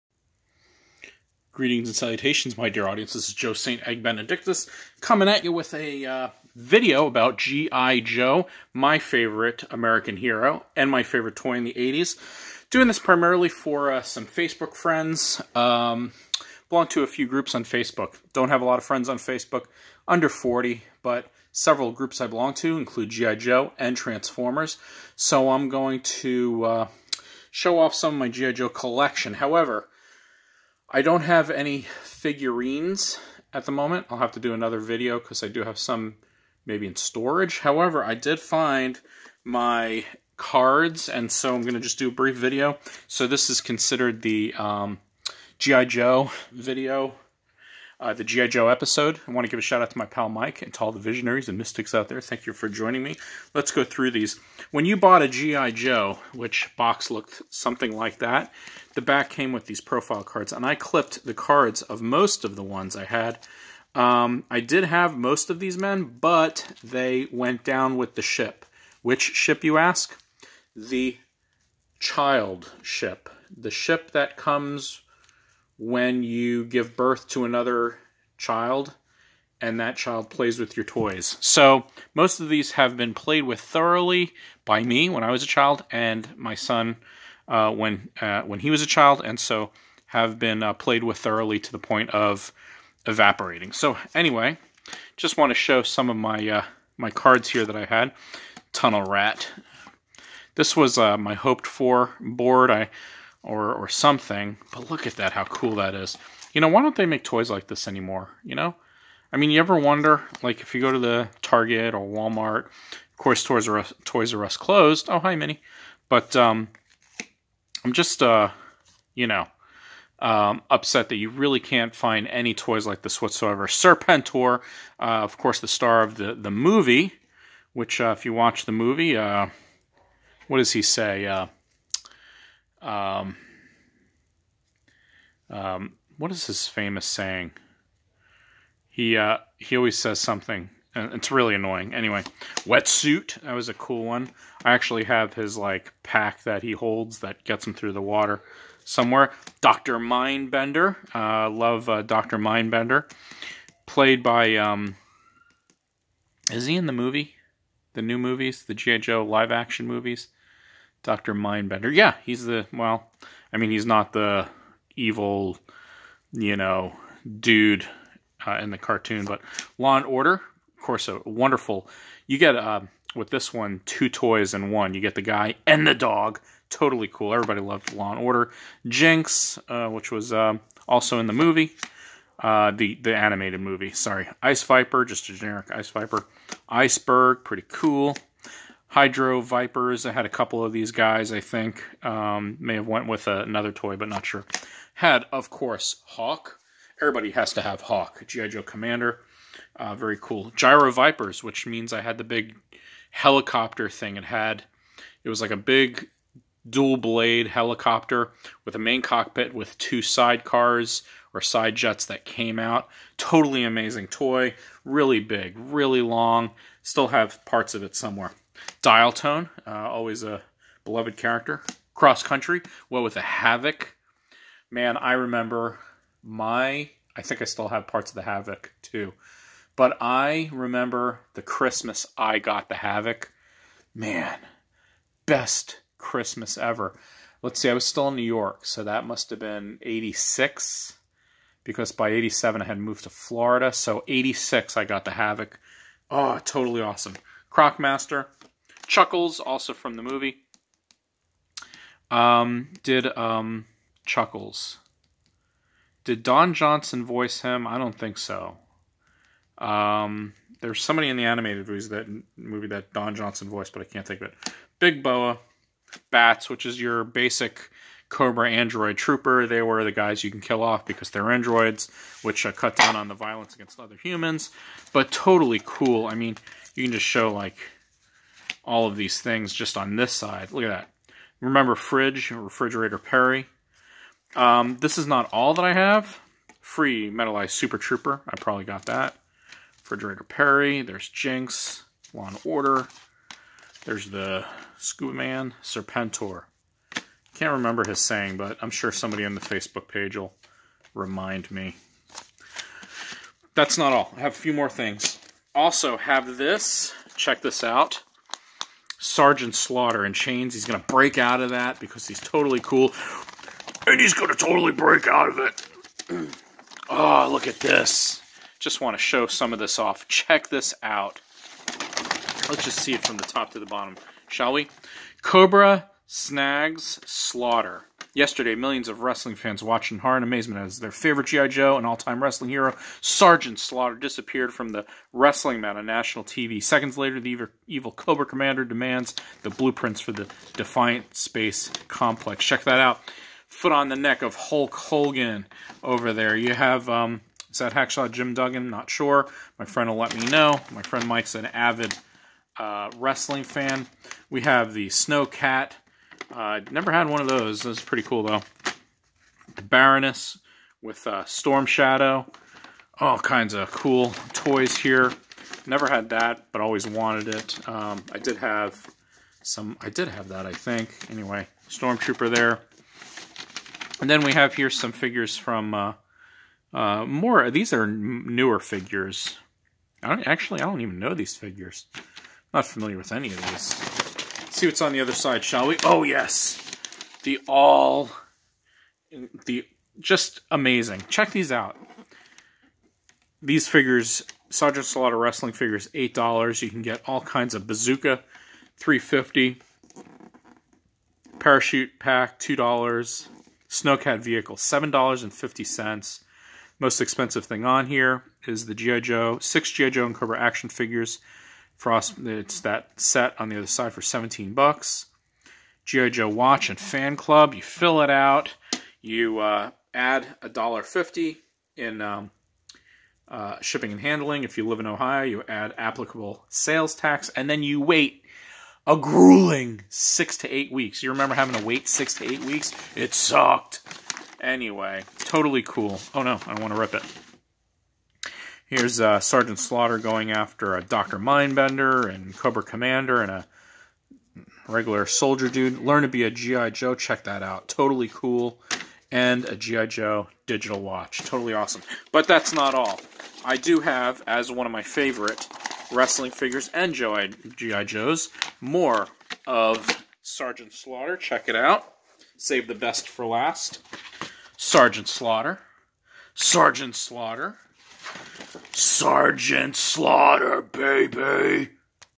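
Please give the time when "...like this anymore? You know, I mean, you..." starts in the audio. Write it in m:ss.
1:47.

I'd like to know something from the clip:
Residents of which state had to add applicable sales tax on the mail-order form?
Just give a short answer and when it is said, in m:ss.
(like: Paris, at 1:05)
Ohio, at 7:04.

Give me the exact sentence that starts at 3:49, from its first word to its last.
But I remember the Christmas I got the Havoc.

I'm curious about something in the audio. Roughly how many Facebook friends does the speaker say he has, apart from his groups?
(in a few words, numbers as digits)
under 40.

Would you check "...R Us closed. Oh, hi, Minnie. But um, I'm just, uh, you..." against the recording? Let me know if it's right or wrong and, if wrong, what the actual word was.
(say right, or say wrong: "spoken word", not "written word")
right.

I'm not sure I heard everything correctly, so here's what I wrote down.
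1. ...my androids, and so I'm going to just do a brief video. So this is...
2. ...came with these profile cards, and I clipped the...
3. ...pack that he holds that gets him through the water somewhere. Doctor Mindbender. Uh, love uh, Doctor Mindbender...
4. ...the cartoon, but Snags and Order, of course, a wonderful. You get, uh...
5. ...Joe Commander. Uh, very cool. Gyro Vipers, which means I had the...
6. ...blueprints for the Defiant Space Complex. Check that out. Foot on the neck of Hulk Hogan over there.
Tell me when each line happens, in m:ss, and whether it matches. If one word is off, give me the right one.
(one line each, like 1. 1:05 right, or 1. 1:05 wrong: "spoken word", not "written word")
1. 0:39 wrong: "cards", not "androids"
2. 0:59 right
3. 2:26 right
4. 2:48 wrong: "Law", not "Snags"
5. 3:18 right
6. 5:39 right.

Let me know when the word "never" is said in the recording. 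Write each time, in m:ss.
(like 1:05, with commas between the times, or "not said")
5:56, 6:05.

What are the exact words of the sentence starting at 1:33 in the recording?
So anyway, just want to show some of my uh, my cards here that I had.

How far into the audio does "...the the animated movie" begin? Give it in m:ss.
3:02.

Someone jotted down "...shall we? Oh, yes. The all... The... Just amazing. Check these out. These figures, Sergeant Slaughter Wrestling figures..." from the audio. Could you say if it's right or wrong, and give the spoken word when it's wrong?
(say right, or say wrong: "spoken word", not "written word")
right.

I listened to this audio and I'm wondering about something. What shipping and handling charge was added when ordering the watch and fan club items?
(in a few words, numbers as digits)
$1.50.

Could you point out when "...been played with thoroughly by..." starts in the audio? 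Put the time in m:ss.
1:22.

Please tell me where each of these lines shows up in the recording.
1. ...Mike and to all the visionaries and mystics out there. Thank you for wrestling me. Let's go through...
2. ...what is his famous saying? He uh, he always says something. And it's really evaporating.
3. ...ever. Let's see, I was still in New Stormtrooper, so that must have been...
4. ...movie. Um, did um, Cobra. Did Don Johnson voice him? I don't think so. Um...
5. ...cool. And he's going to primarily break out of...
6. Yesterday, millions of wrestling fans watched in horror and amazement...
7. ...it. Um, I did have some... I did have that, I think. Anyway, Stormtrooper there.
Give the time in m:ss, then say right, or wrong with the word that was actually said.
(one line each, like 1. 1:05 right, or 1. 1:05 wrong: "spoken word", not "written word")
1. 0:50 wrong: "joining", not "wrestling"
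2. 2:16 wrong: "annoying", not "evaporating"
3. 3:56 wrong: "York", not "Stormtrooper"
4. 4:10 wrong: "Chuckles", not "Cobra"
5. 5:12 wrong: "totally", not "primarily"
6. 5:28 right
7. 6:07 right.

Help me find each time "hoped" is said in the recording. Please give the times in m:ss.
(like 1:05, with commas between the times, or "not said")
1:41.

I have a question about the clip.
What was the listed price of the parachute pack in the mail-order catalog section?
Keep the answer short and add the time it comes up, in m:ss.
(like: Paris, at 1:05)
$2, at 6:42.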